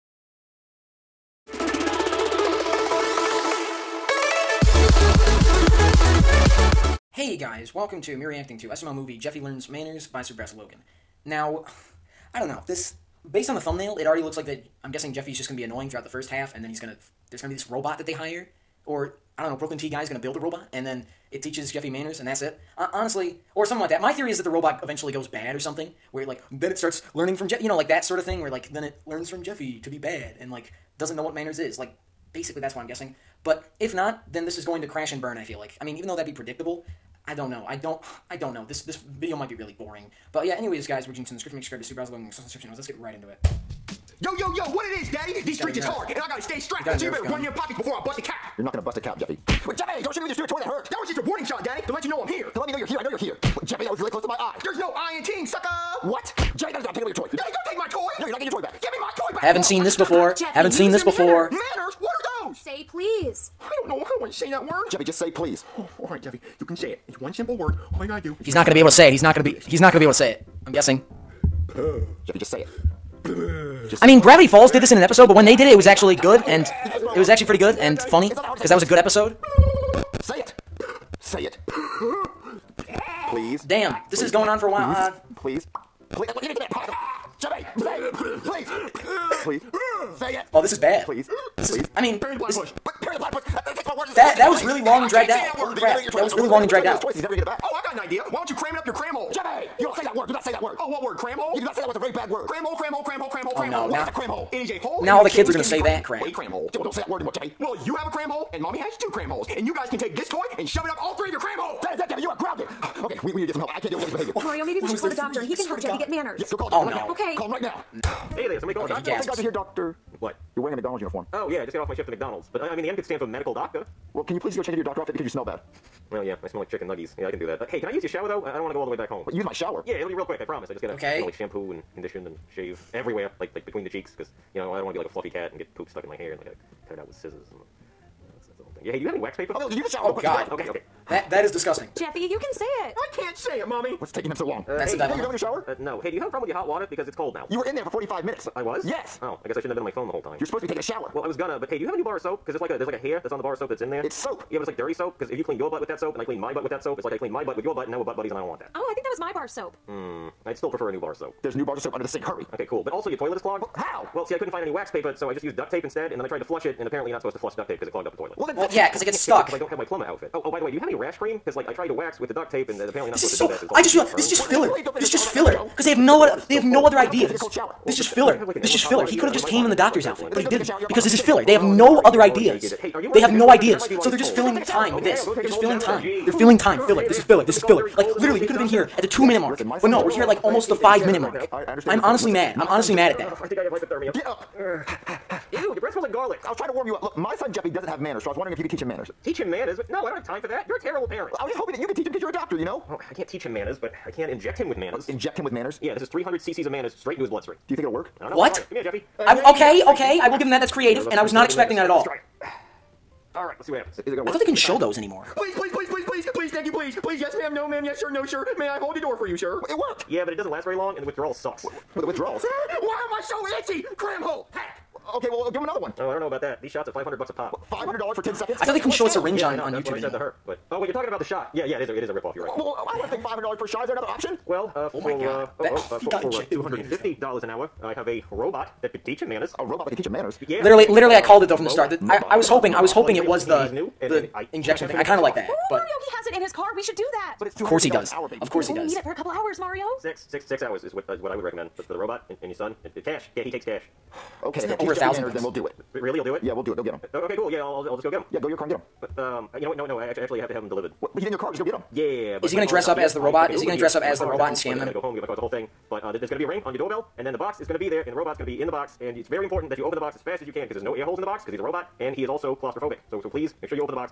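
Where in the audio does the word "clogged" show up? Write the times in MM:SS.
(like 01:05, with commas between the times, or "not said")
02:43, 02:47.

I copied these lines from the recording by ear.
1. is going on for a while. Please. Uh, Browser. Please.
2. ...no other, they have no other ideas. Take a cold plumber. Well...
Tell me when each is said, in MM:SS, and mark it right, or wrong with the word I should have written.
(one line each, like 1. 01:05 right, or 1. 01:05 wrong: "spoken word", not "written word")
1. 01:24 wrong: "Please", not "Browser"
2. 02:55 wrong: "shower", not "plumber".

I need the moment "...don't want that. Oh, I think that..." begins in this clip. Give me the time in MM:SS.
02:38.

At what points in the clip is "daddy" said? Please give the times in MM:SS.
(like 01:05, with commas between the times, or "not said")
00:45, 00:51, 00:57.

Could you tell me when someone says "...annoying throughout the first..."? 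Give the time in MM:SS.
00:15.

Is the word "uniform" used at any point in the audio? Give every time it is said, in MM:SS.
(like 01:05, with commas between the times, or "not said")
02:01.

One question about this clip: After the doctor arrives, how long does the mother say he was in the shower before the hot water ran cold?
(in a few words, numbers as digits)
45 minutes.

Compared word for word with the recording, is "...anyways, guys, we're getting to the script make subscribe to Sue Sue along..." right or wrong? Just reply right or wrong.
wrong.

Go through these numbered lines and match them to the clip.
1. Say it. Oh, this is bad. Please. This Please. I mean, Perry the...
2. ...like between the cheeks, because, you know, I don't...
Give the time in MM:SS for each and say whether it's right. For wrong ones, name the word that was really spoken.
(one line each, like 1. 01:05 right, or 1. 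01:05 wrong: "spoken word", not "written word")
1. 01:30 right
2. 02:13 right.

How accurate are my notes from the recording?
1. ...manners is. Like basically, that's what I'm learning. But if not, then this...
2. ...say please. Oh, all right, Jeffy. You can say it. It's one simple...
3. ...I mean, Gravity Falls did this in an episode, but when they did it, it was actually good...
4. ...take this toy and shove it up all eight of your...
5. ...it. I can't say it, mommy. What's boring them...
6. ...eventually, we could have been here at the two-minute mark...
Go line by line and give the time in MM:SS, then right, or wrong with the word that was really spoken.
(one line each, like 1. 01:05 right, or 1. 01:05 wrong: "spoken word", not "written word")
1. 00:31 wrong: "guessing", not "learning"
2. 01:05 right
3. 01:14 right
4. 01:49 wrong: "three", not "eight"
5. 02:22 wrong: "taking", not "boring"
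6. 03:08 wrong: "literally", not "eventually".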